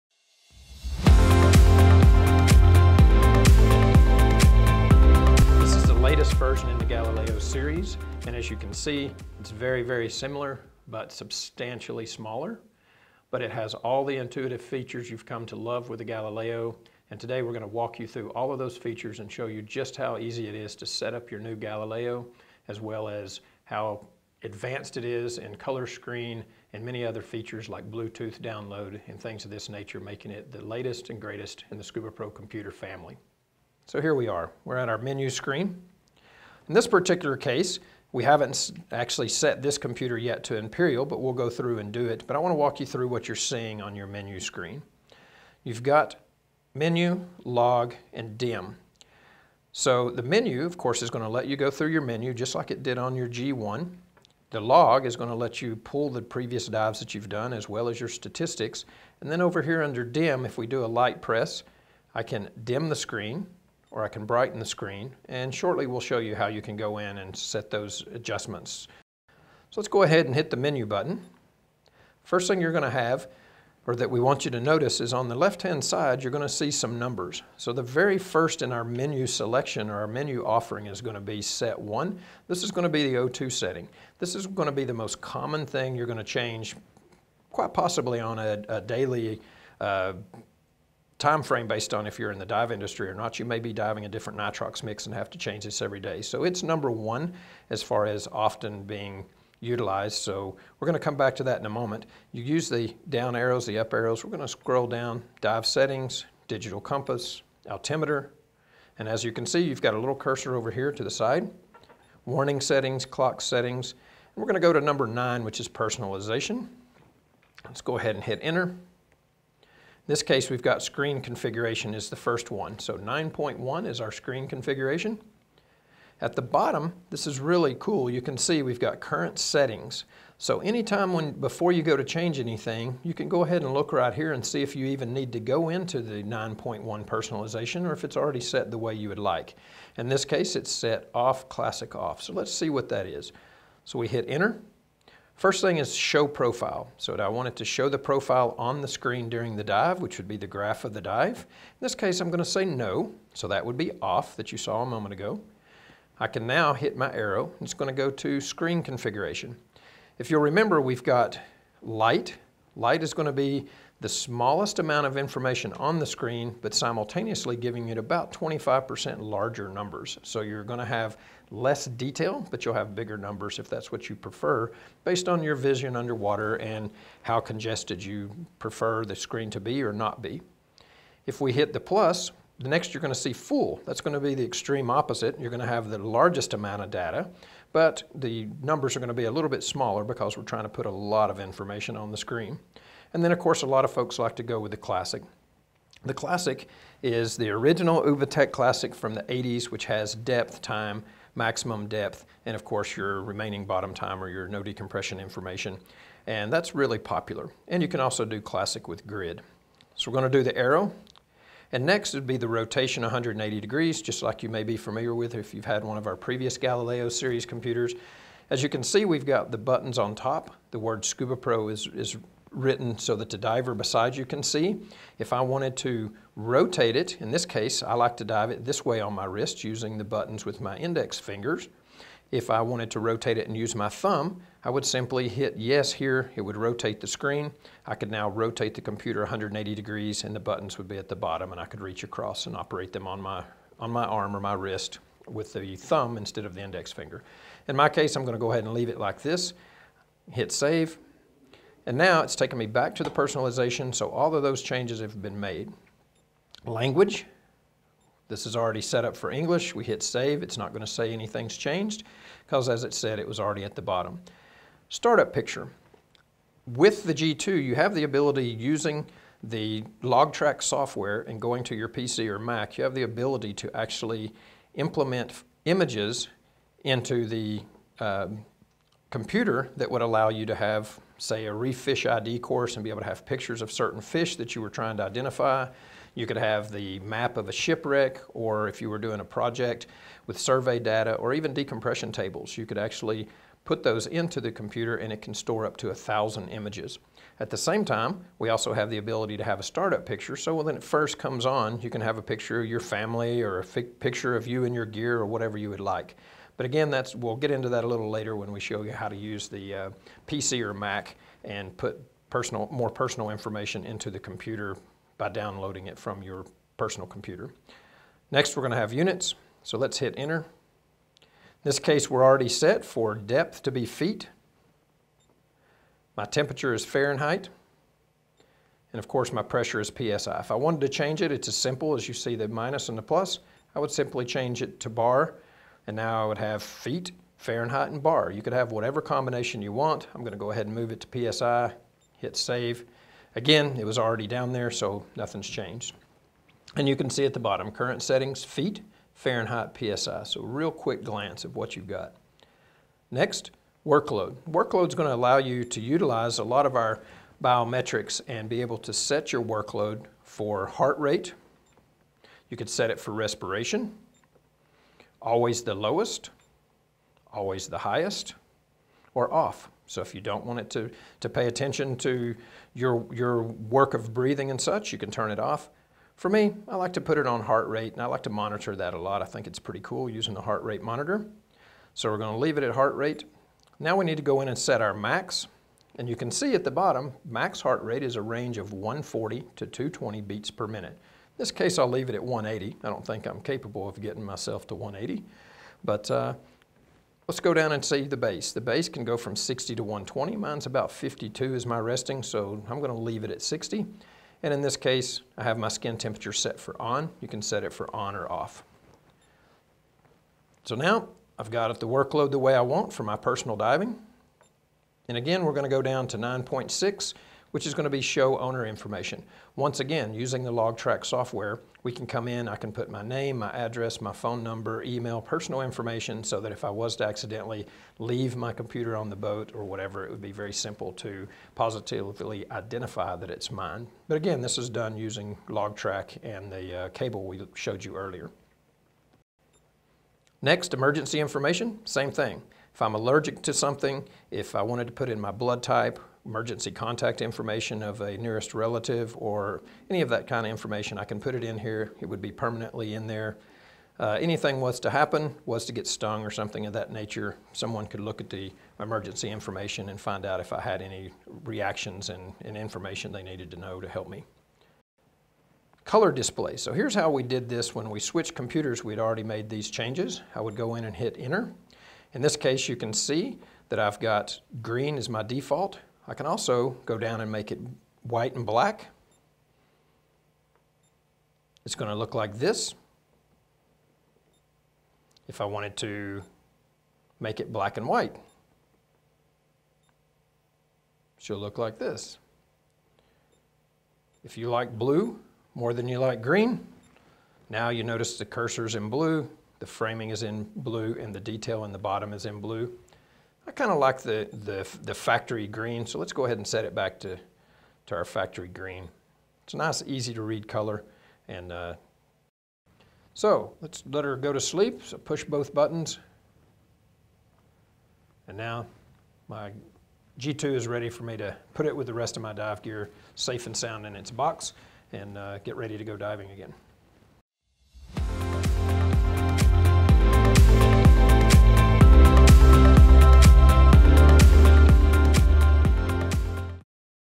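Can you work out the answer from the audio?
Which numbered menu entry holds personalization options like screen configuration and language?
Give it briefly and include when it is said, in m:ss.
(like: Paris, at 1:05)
9, at 1:54.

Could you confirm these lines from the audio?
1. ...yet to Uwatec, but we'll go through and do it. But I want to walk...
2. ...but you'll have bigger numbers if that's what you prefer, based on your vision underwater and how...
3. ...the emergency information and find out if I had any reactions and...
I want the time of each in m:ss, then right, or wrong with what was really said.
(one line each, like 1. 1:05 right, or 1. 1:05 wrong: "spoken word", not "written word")
1. 0:40 wrong: "Imperial", not "Uwatec"
2. 2:52 right
3. 7:38 right.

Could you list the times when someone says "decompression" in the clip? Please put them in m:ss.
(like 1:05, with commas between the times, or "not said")
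3:24, 4:51.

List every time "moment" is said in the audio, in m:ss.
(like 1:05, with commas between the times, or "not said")
1:41, 2:34.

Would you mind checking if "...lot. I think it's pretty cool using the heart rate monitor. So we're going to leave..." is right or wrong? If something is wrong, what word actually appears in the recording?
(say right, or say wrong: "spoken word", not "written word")
right.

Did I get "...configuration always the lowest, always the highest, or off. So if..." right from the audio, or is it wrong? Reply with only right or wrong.
wrong.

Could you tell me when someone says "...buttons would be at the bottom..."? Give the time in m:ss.
4:00.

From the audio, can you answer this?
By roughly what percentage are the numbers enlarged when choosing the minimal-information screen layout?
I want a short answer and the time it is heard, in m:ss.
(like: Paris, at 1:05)
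25%, at 2:48.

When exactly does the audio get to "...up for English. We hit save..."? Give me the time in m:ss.
4:19.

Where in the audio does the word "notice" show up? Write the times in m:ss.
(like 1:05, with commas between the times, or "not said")
1:14, 8:17.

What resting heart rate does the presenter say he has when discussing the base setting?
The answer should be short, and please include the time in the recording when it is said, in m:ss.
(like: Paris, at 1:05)
52, at 6:40.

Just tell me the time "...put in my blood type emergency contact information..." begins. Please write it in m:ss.
7:24.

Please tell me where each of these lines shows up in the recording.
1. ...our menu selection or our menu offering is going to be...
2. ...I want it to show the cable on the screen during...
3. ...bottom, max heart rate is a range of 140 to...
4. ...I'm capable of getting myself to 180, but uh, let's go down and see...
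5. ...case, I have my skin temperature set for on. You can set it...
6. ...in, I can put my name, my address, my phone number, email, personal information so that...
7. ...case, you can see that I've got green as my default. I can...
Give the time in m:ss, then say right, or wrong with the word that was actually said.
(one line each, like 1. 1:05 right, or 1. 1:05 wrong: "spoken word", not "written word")
1. 1:18 right
2. 2:27 wrong: "profile", not "cable"
3. 6:26 right
4. 6:33 right
5. 6:44 right
6. 7:02 right
7. 7:52 right.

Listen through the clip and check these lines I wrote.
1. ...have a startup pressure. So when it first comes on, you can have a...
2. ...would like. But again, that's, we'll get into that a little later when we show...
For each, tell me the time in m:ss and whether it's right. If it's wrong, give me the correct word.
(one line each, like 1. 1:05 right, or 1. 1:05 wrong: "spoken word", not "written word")
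1. 4:59 wrong: "picture", not "pressure"
2. 5:05 right.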